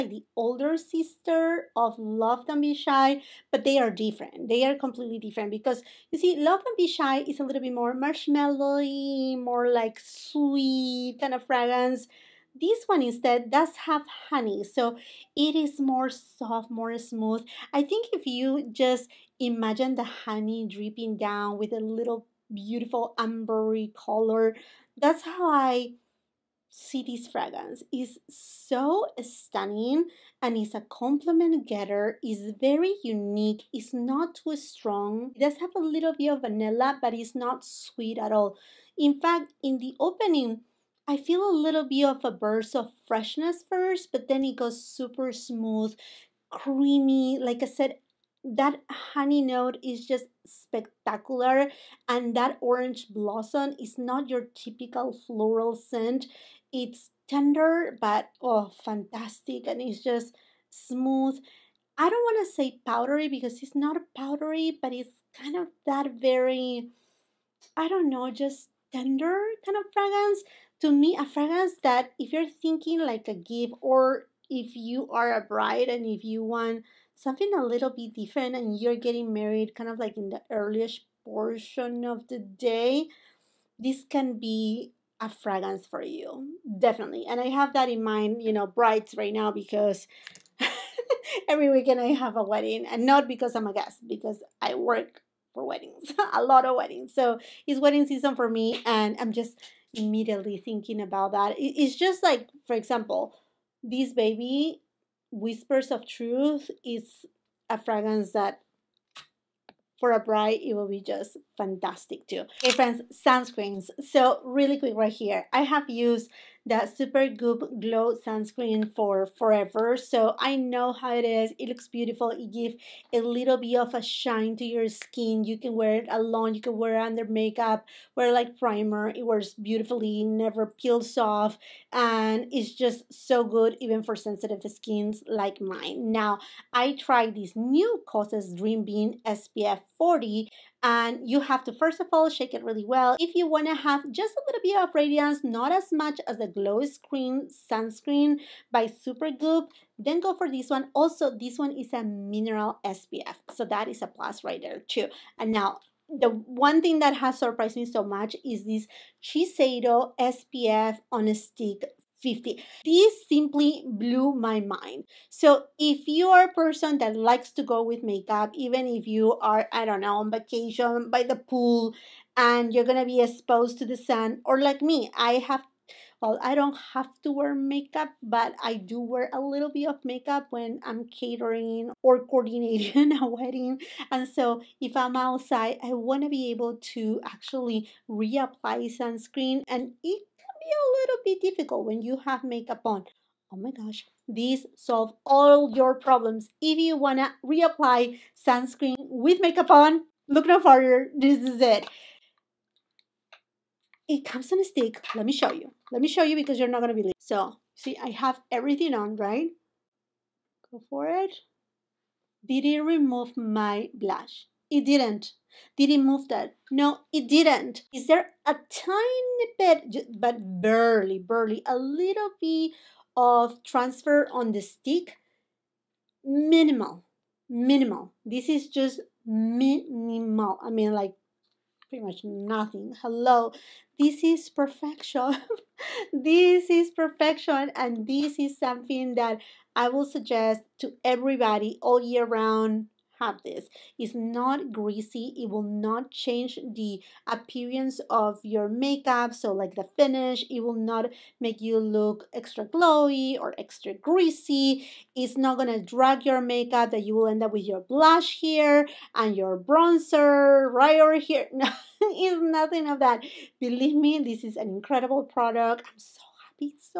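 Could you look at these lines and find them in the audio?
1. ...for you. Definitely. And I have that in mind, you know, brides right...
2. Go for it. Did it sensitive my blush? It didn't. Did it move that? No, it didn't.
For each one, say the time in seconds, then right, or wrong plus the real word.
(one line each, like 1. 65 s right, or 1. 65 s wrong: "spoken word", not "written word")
1. 85 s right
2. 210 s wrong: "remove", not "sensitive".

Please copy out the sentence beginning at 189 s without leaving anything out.
And it be a little bit difficult when you have makeup on.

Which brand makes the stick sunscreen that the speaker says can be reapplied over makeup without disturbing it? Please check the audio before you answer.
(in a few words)
Shiseido.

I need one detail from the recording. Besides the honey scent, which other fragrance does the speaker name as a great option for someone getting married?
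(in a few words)
Whispers of Truth.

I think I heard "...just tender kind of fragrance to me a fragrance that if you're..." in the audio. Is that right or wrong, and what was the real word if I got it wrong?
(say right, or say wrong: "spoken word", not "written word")
right.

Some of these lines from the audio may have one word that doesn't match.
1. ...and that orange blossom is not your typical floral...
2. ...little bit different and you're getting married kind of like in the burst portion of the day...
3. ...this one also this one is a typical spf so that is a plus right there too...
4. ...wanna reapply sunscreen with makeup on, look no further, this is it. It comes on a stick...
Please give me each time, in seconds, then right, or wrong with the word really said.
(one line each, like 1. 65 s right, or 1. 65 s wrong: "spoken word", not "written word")
1. 52 s right
2. 77 s wrong: "earliest", not "burst"
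3. 150 s wrong: "mineral", not "typical"
4. 196 s right.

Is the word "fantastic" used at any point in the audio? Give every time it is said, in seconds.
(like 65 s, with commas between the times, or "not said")
58 s, 111 s.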